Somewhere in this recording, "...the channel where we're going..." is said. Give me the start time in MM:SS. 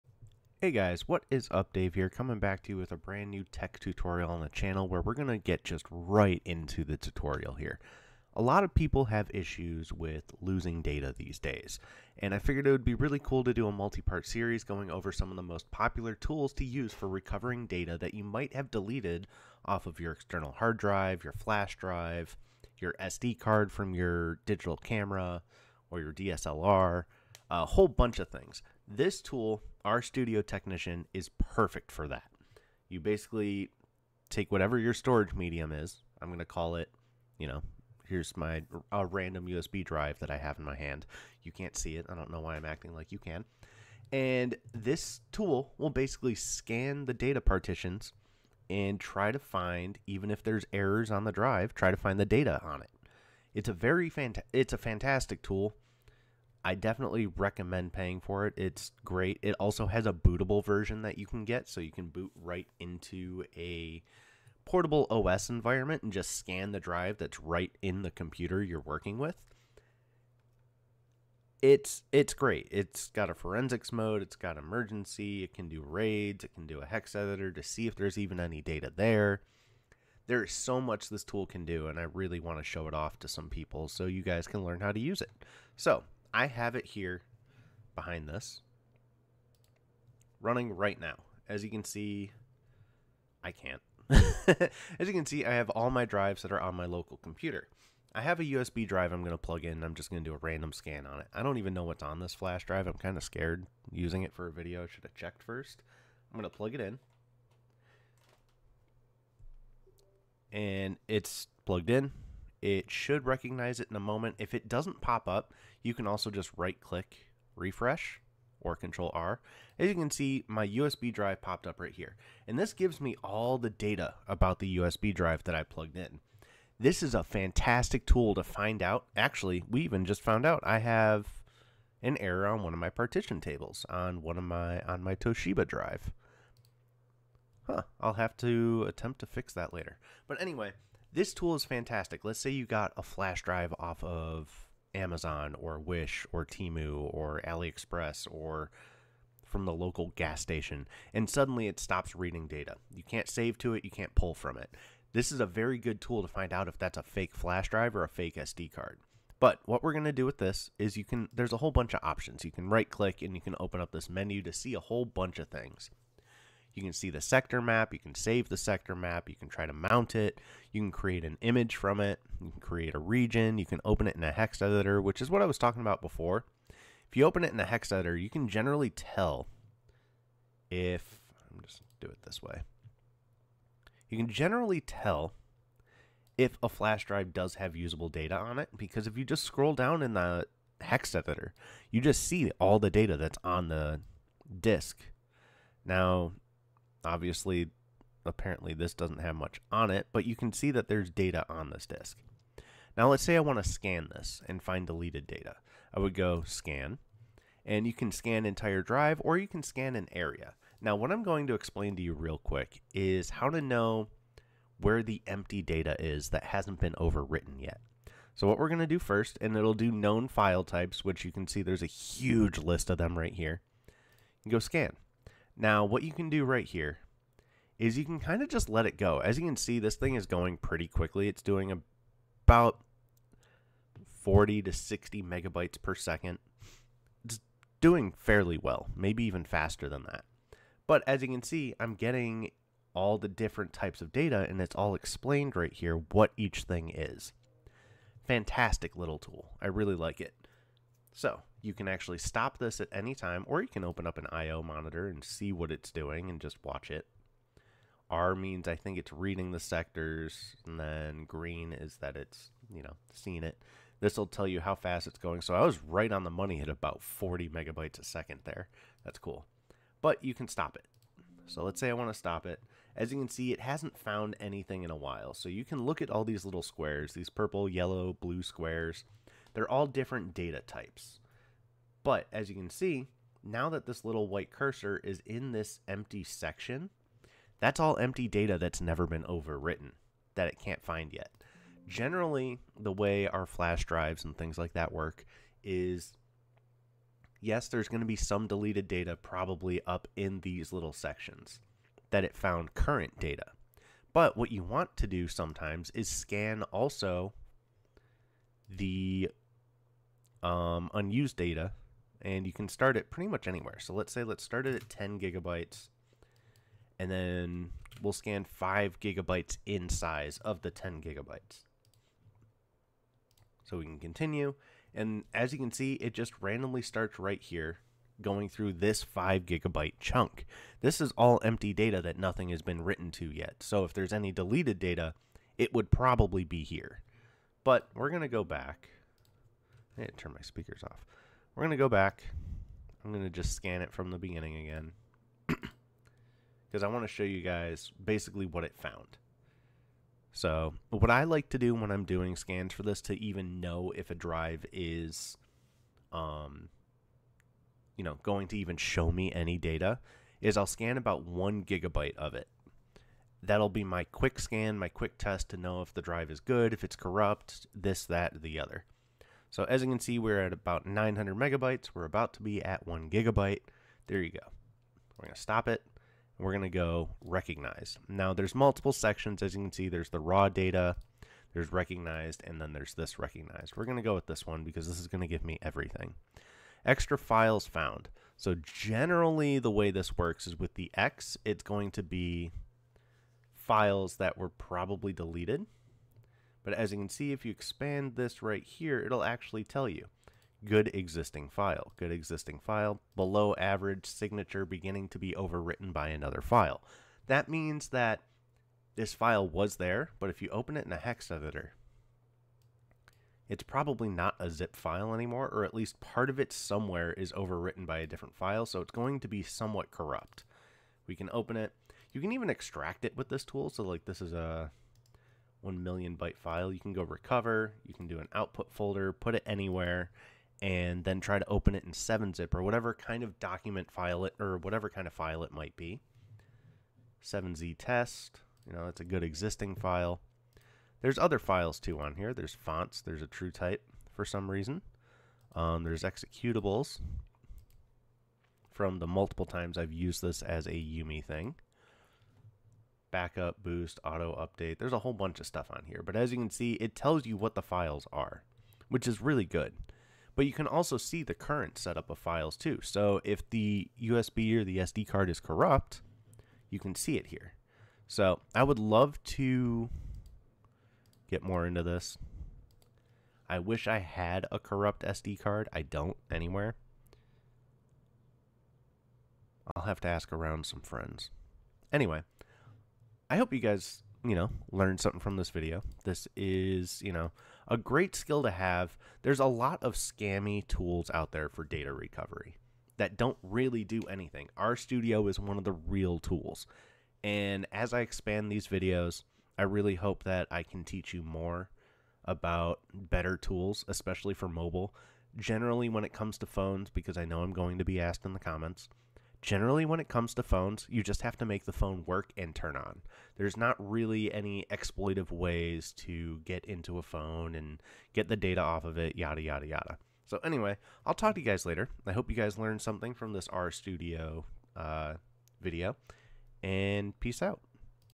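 00:04.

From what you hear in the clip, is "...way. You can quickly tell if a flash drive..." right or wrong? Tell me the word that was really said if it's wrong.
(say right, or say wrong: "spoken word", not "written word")
wrong: "generally", not "quickly".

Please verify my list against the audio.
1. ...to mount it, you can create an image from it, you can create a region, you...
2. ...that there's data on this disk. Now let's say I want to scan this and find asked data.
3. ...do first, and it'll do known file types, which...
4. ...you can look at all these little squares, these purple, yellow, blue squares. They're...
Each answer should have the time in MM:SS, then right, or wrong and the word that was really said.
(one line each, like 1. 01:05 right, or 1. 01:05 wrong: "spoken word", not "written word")
1. 02:49 right
2. 03:20 wrong: "deleted", not "asked"
3. 03:38 right
4. 04:35 right.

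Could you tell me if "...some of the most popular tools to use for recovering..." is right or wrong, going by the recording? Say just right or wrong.
right.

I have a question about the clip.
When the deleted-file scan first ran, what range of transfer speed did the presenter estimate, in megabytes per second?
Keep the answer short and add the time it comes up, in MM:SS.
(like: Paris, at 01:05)
40 to 60, at 03:54.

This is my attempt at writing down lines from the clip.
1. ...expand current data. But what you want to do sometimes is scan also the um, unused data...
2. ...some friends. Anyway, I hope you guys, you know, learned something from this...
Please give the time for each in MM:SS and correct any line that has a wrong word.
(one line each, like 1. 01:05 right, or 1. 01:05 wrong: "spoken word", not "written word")
1. 05:02 wrong: "found", not "expand"
2. 08:00 right.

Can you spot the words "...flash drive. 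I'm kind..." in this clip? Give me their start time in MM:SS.
01:42.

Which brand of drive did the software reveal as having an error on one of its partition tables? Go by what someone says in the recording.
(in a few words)
Toshiba.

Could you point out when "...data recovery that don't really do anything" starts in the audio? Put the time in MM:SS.
08:11.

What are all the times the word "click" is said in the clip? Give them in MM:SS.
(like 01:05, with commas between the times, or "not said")
01:56, 02:42.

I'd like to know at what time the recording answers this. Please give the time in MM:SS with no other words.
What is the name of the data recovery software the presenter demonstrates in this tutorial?
00:29.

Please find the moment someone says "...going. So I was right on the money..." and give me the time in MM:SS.
04:25.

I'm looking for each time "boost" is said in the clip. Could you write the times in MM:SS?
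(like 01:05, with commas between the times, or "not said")
07:33.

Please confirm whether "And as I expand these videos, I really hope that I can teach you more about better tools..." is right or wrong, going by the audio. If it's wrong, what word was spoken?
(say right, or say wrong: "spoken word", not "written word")
right.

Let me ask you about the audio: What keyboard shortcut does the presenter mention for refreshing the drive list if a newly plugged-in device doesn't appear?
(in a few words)
Control R.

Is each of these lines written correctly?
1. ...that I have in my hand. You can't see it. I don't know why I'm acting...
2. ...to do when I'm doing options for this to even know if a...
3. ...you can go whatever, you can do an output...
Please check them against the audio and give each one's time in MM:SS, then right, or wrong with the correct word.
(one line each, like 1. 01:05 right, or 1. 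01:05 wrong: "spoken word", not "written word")
1. 00:40 right
2. 05:51 wrong: "scans", not "options"
3. 07:06 wrong: "recover", not "whatever".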